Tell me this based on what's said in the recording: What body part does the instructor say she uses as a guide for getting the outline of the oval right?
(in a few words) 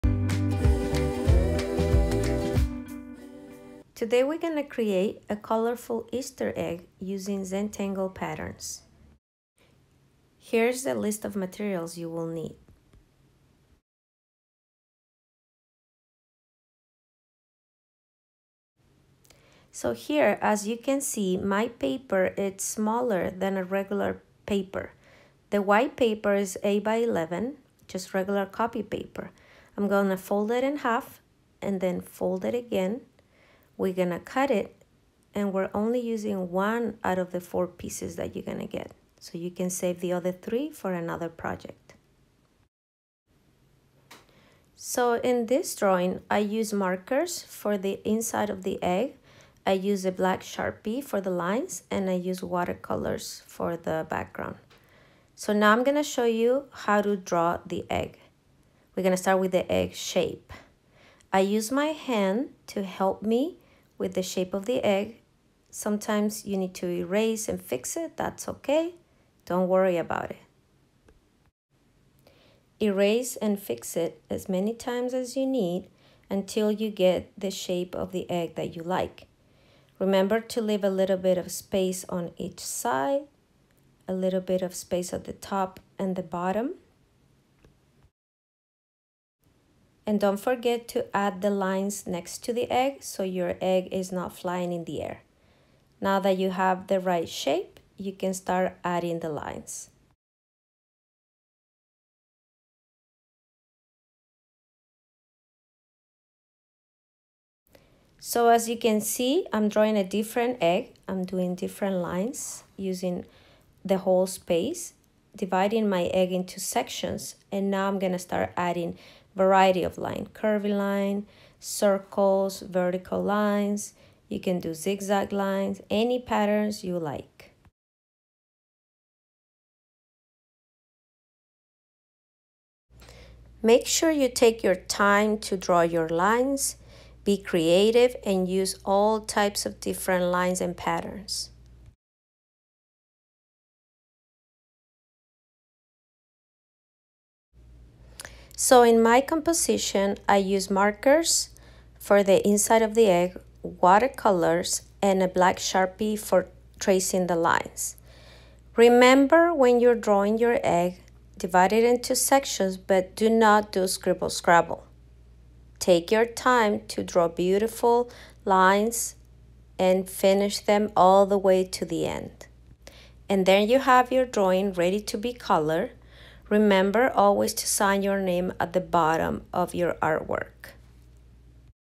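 Hand.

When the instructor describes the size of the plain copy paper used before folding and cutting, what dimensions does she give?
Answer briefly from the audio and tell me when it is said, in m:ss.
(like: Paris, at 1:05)
8 by 11, at 0:26.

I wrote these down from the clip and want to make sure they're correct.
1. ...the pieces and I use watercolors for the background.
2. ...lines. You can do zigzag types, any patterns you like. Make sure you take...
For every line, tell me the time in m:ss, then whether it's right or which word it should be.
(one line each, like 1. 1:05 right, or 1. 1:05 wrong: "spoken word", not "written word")
1. 0:51 wrong: "lines", not "pieces"
2. 2:03 wrong: "lines", not "types".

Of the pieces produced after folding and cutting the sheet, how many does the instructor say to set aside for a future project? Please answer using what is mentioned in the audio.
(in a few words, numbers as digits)
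3.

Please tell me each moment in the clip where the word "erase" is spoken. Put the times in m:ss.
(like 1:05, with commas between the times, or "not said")
1:06, 1:12.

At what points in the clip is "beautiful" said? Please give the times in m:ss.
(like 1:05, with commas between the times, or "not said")
2:47.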